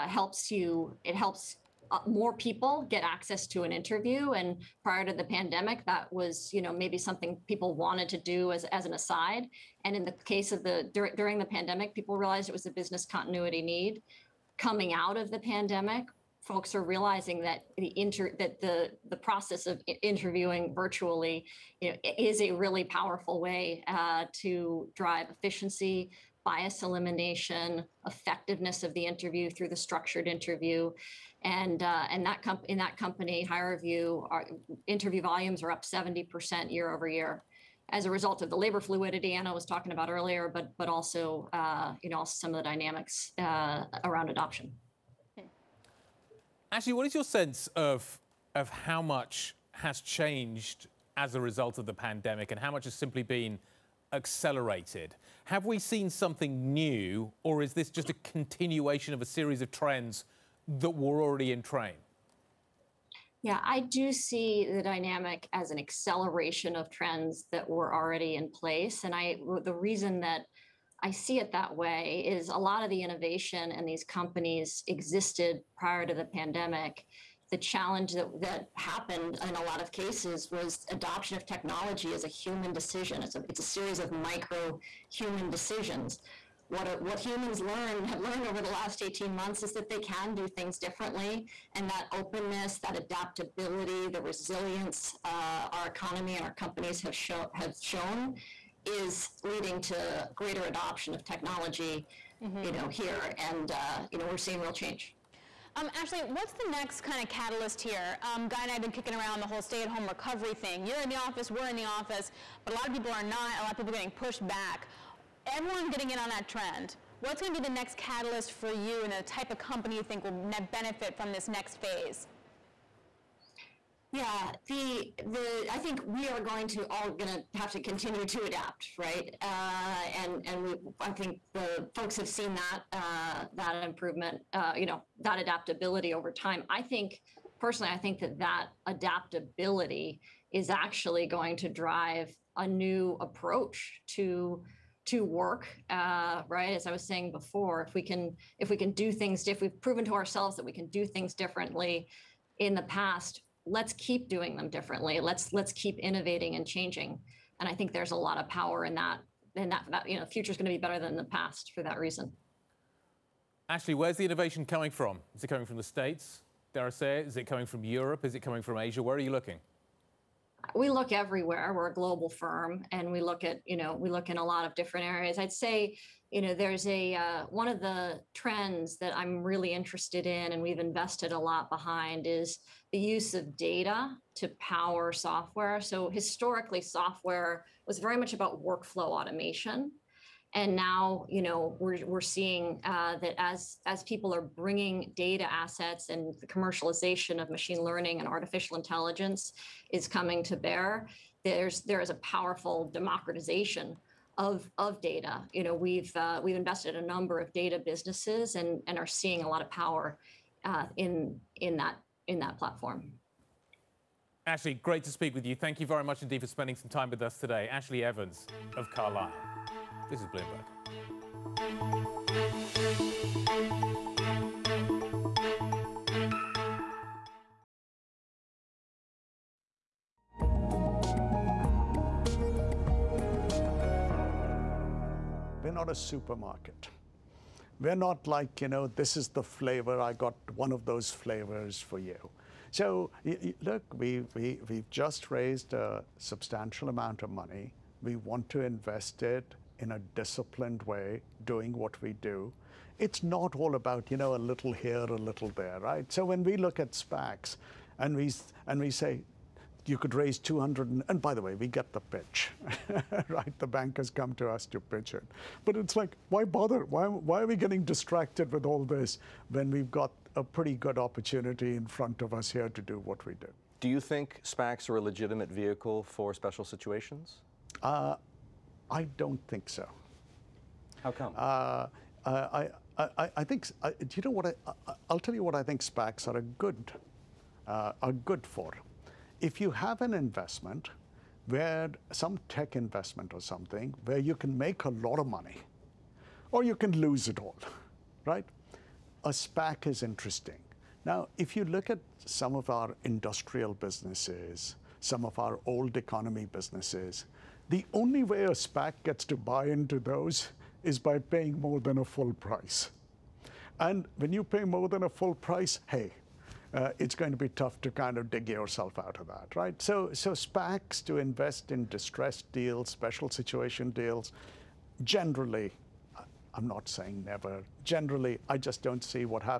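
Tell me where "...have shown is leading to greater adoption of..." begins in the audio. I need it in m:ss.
1:37.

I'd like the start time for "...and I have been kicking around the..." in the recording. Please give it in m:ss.
1:48.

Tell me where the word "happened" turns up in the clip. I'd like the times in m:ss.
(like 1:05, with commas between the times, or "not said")
1:18.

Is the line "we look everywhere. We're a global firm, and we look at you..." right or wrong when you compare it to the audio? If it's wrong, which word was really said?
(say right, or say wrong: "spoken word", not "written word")
right.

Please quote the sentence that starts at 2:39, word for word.
And that, that you know, future is going to be better than the past for that reason.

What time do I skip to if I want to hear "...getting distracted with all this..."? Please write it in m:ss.
4:27.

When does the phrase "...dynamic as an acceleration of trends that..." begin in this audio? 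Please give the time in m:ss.
1:04.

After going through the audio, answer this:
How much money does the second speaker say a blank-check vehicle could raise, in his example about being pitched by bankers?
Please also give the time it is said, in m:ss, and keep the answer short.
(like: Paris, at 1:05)
200, at 4:20.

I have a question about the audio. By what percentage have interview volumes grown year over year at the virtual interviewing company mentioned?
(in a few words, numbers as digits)
70%.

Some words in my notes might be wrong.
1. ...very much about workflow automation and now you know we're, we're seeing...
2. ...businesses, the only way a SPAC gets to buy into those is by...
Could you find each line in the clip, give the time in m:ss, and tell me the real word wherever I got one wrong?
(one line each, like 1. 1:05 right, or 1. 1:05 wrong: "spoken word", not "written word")
1. 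3:07 right
2. 5:06 right.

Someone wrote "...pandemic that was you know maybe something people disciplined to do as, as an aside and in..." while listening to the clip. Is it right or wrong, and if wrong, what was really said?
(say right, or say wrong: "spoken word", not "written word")
wrong: "wanted", not "disciplined".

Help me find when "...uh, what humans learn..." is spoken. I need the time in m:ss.
1:26.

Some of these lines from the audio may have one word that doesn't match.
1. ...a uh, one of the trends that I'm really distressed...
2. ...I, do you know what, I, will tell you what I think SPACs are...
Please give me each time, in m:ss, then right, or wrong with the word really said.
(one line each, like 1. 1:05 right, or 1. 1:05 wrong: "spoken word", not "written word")
1. 2:56 wrong: "interested", not "distressed"
2. 4:43 right.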